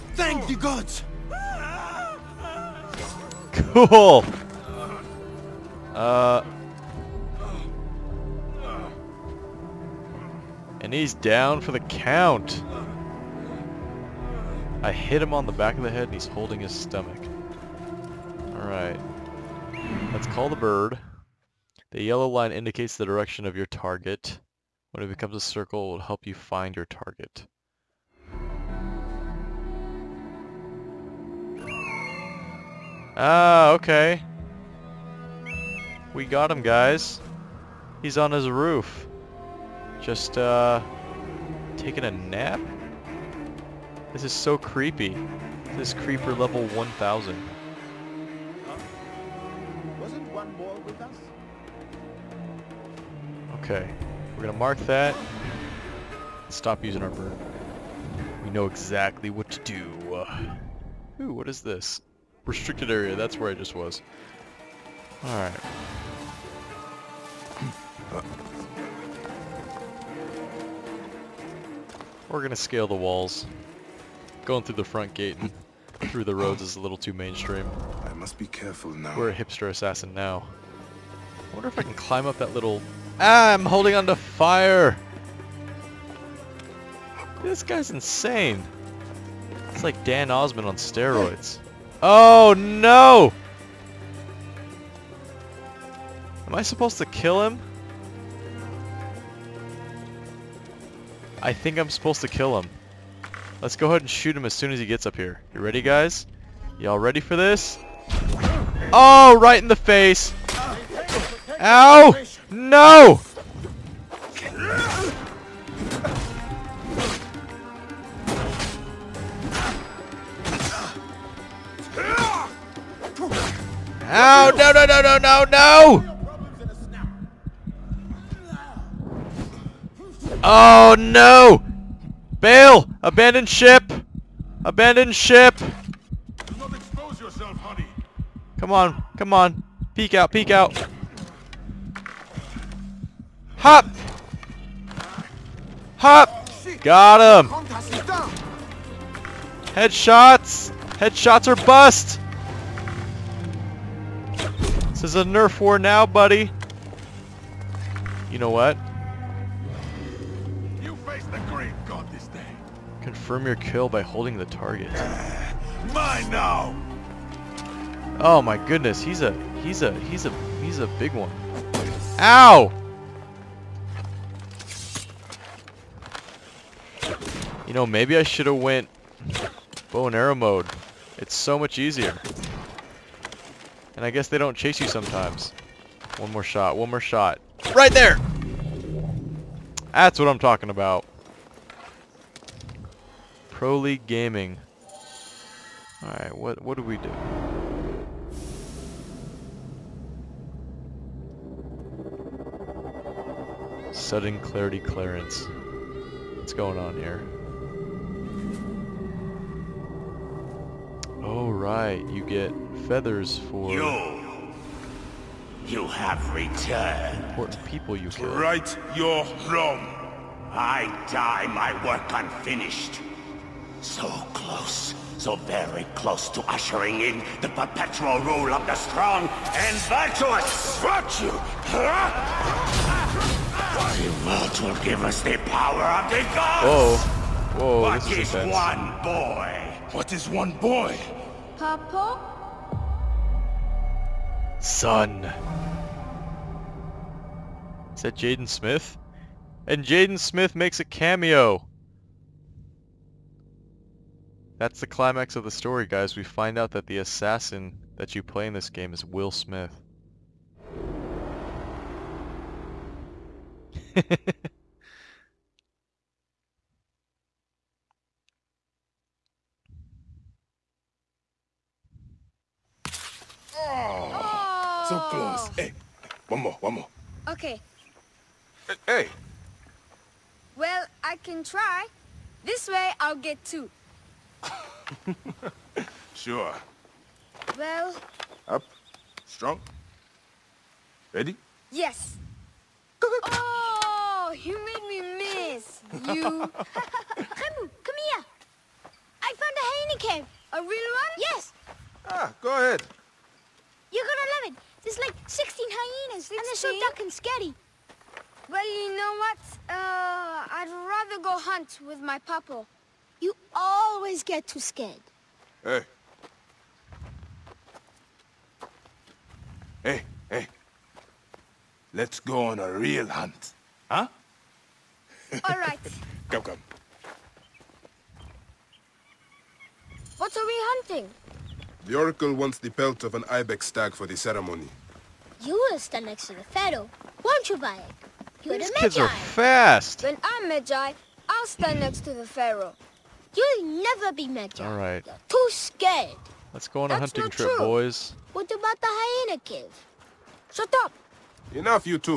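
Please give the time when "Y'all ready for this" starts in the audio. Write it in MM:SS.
01:46.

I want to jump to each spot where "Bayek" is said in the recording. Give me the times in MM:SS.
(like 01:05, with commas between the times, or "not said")
05:37.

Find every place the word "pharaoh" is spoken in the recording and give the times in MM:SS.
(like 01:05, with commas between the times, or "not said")
05:36, 05:42.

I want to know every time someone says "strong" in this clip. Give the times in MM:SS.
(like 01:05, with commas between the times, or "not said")
03:48, 04:49.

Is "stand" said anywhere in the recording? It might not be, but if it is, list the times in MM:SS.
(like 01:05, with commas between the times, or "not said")
05:35, 05:41.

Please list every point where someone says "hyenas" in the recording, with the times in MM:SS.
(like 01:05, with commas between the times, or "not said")
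05:05, 05:48.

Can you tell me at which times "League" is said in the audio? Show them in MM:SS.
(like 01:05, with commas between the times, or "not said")
03:13.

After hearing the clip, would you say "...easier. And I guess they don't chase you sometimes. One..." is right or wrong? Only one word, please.
right.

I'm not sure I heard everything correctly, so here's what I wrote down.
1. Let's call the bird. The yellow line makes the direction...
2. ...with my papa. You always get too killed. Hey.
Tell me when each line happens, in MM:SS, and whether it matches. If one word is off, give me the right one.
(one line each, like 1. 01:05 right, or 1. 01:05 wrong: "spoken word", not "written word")
1. 00:20 wrong: "indicates", not "makes"
2. 05:11 wrong: "scared", not "killed".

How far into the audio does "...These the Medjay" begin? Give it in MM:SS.
05:38.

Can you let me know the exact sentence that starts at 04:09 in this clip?
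And Jaden Smith makes a cameo!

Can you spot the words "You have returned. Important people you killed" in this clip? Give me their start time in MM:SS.
03:35.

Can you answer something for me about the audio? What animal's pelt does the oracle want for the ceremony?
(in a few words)
ibex stag.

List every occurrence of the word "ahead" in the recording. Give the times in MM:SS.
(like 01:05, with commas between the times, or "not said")
01:43, 05:02.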